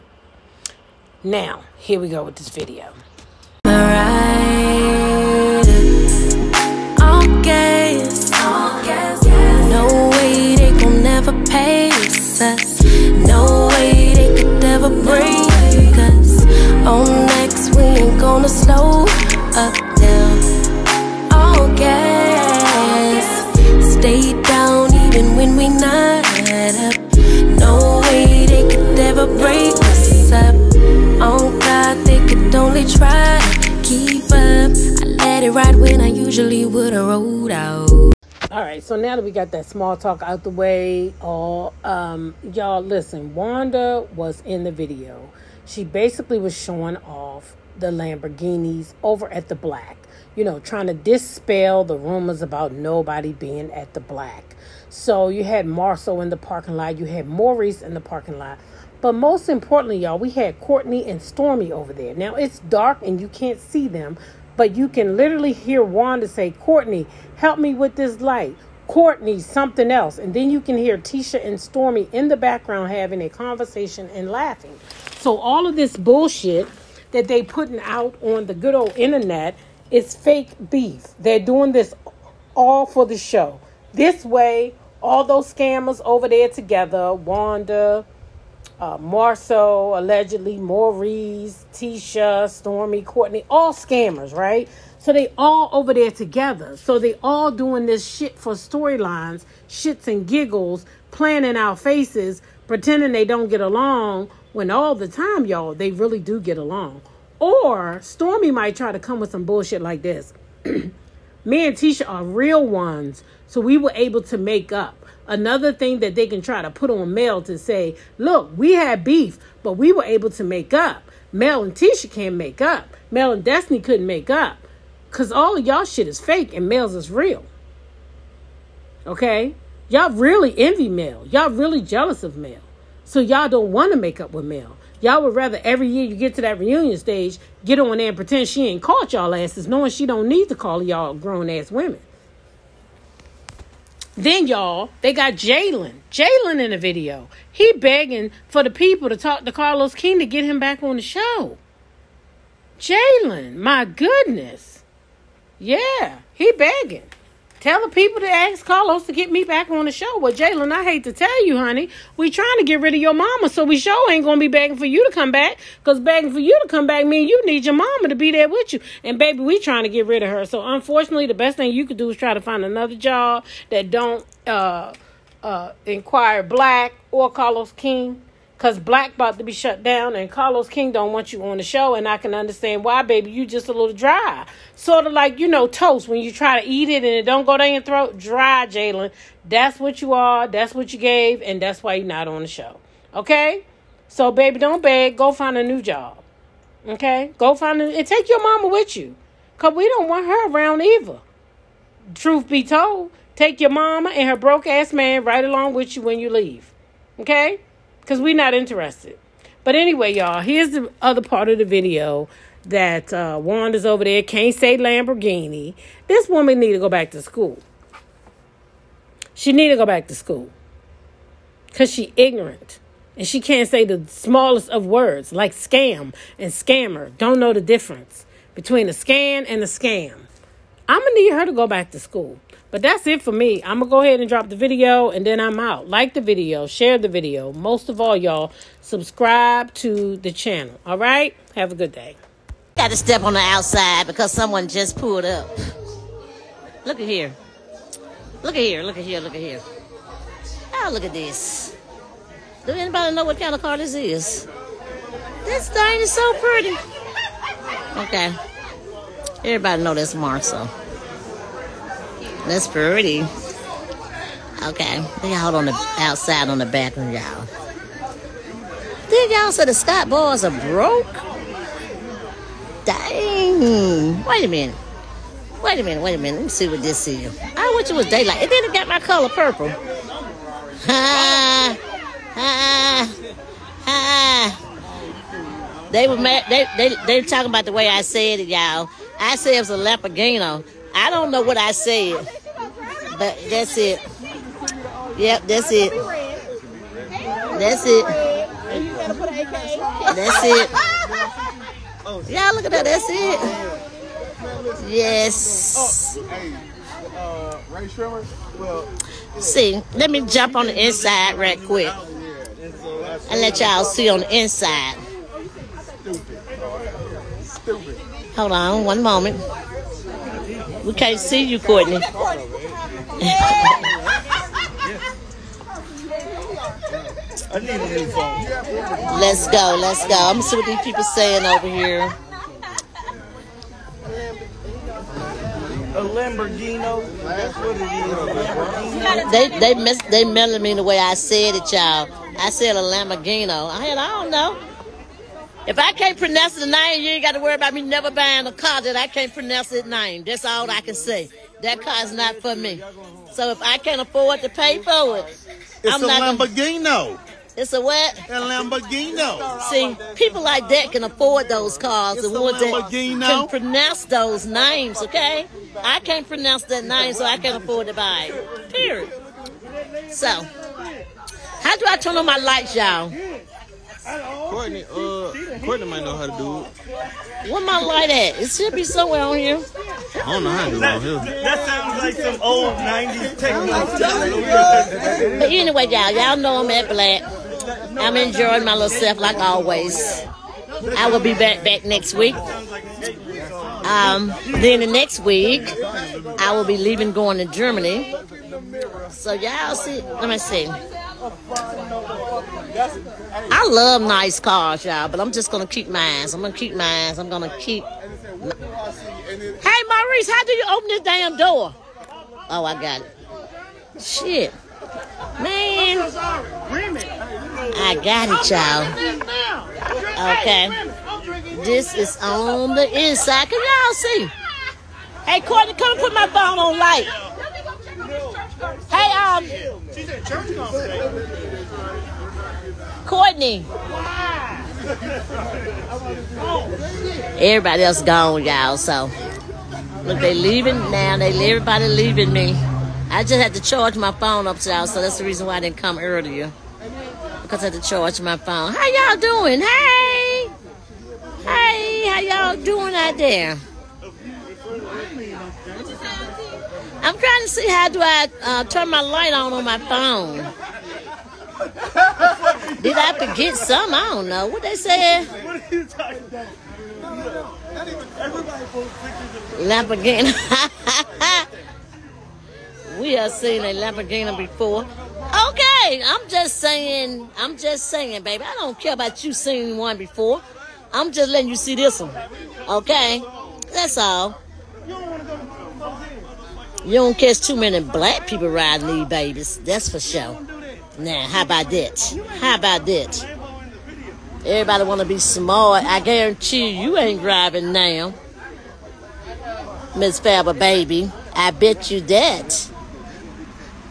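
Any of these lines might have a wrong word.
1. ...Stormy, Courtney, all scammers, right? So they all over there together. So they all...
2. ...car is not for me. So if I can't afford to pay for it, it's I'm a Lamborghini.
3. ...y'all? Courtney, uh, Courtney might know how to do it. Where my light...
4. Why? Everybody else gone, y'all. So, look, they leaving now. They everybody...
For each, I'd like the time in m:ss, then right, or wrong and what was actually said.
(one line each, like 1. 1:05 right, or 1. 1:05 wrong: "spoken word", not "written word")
1. 1:32 right
2. 5:51 right
3. 6:12 right
4. 7:13 right.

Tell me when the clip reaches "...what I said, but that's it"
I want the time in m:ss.
4:51.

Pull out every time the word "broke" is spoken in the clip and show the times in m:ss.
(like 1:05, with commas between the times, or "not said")
3:24, 4:30.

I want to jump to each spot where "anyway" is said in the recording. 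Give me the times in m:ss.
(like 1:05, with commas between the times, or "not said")
3:29, 6:25.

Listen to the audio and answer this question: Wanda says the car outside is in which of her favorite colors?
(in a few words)
Purple.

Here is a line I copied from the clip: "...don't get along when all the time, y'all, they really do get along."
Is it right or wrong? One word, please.
right.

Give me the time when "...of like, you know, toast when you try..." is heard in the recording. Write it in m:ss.
3:05.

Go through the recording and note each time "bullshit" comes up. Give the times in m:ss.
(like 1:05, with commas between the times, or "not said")
1:15, 1:49.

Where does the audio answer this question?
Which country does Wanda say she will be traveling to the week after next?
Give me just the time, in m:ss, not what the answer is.
6:37.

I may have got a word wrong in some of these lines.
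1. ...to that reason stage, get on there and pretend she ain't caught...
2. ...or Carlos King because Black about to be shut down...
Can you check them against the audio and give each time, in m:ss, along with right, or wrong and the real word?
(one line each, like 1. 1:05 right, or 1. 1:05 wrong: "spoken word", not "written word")
1. 2:16 wrong: "reunion", not "reason"
2. 2:57 right.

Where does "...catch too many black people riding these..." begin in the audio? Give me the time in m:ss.
8:07.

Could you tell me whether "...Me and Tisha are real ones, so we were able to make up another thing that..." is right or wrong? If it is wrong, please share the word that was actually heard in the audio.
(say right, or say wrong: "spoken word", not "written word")
right.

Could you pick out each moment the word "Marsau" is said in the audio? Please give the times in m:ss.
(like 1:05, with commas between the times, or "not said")
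0:55, 4:20.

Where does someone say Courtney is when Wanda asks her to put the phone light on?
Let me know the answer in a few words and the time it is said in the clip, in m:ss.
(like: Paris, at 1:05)
Church conference, at 7:10.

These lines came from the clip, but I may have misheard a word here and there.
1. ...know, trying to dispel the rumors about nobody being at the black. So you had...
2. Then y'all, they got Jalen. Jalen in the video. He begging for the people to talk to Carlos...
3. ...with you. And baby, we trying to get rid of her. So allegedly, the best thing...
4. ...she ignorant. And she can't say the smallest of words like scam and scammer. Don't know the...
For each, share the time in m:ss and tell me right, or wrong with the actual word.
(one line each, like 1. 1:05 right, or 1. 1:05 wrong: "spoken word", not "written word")
1. 0:50 right
2. 2:24 right
3. 2:48 wrong: "unfortunately", not "allegedly"
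4. 3:41 right.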